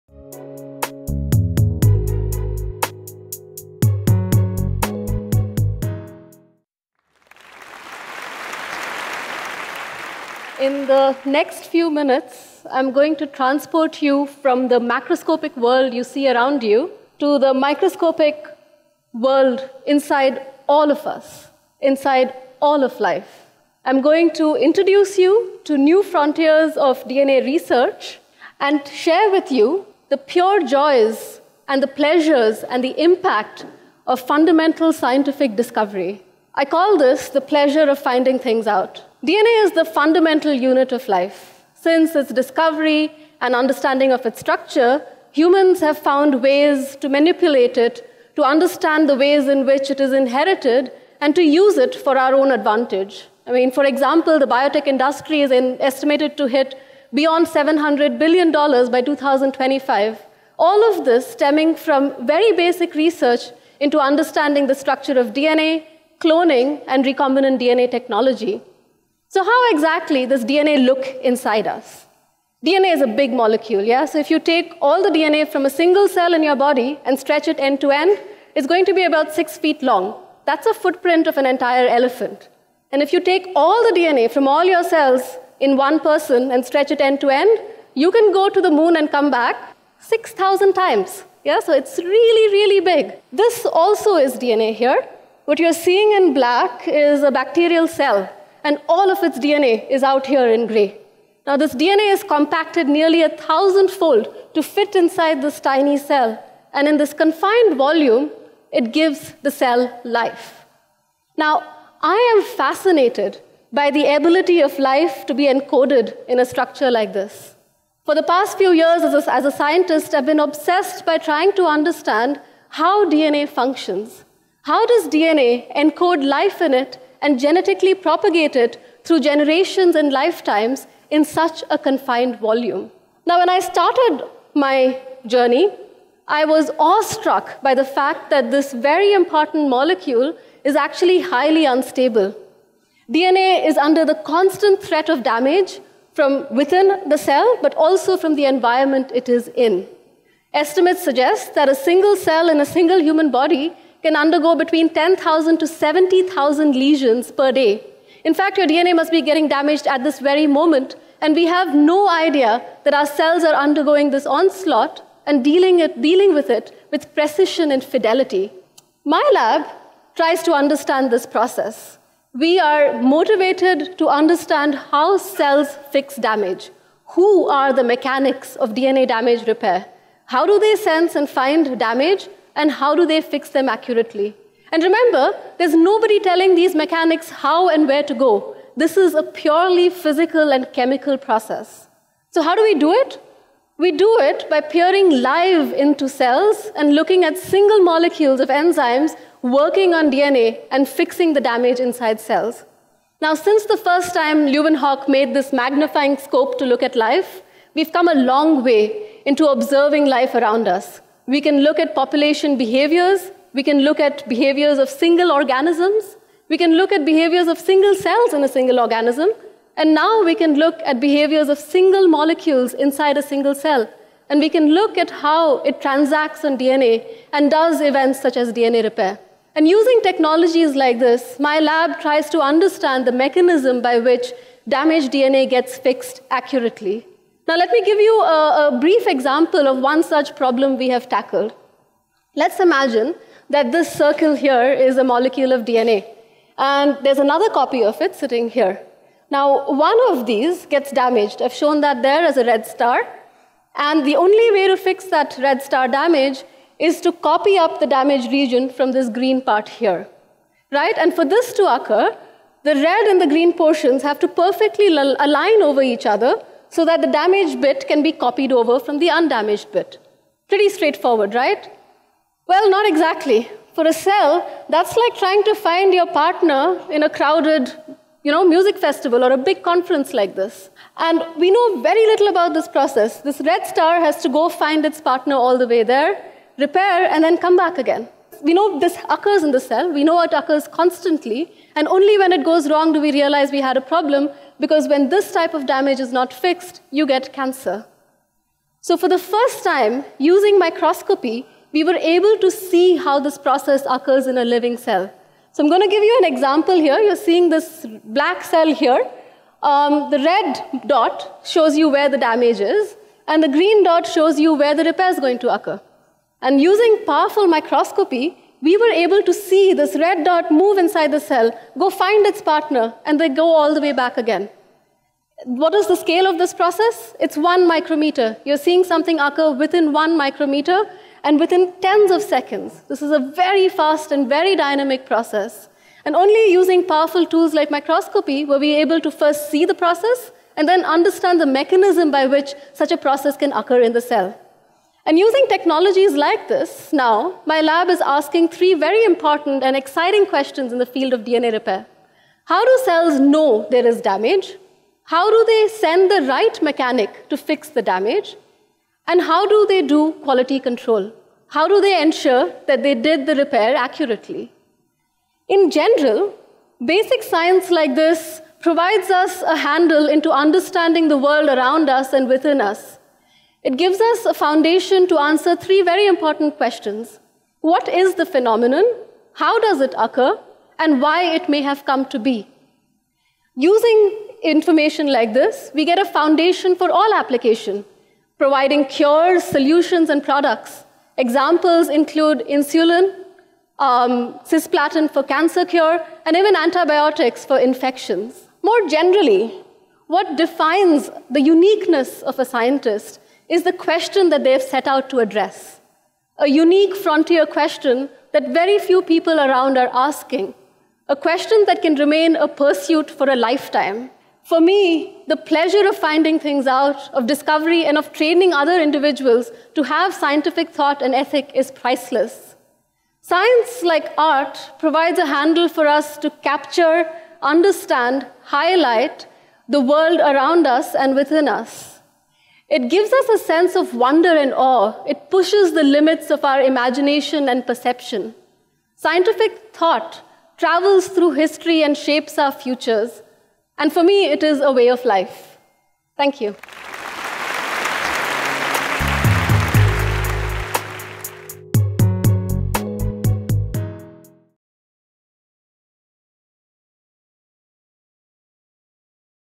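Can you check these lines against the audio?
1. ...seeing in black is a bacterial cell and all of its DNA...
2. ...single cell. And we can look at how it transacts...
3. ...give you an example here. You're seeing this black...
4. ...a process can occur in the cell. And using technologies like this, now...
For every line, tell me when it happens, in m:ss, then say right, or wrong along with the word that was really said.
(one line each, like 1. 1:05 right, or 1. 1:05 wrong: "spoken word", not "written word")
1. 1:35 right
2. 3:43 right
3. 5:05 right
4. 5:42 right.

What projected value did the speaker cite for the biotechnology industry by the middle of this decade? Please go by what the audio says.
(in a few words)
$700 billion.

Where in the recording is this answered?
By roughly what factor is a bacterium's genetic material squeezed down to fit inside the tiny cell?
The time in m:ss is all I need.
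1:42.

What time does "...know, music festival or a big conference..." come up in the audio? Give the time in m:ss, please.
4:38.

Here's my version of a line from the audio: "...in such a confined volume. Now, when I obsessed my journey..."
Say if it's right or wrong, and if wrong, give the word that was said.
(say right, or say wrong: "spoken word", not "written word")
wrong: "started", not "obsessed".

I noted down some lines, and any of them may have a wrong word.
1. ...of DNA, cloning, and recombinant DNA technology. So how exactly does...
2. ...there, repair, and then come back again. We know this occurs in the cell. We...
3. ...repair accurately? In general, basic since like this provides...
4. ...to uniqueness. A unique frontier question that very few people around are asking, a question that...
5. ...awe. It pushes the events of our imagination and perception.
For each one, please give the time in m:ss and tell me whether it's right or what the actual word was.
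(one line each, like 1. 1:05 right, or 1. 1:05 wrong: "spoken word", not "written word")
1. 1:05 right
2. 4:45 right
3. 6:03 wrong: "science", not "since"
4. 6:45 wrong: "address", not "uniqueness"
5. 7:14 wrong: "limits", not "events".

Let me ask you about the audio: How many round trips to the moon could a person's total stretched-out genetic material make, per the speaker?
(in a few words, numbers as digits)
6,000.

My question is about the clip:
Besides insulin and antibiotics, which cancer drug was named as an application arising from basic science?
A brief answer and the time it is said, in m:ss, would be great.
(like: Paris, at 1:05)
cisplatin, at 6:34.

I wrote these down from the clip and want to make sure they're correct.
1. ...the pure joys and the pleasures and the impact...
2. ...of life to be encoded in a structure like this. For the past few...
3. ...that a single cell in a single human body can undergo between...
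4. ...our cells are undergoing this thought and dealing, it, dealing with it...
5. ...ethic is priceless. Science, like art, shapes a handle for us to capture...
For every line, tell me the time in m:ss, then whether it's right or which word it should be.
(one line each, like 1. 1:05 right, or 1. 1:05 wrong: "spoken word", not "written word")
1. 0:30 right
2. 1:54 right
3. 2:31 right
4. 2:42 wrong: "onslaught", not "thought"
5. 7:01 wrong: "provides", not "shapes".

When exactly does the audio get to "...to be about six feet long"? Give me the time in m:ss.
1:18.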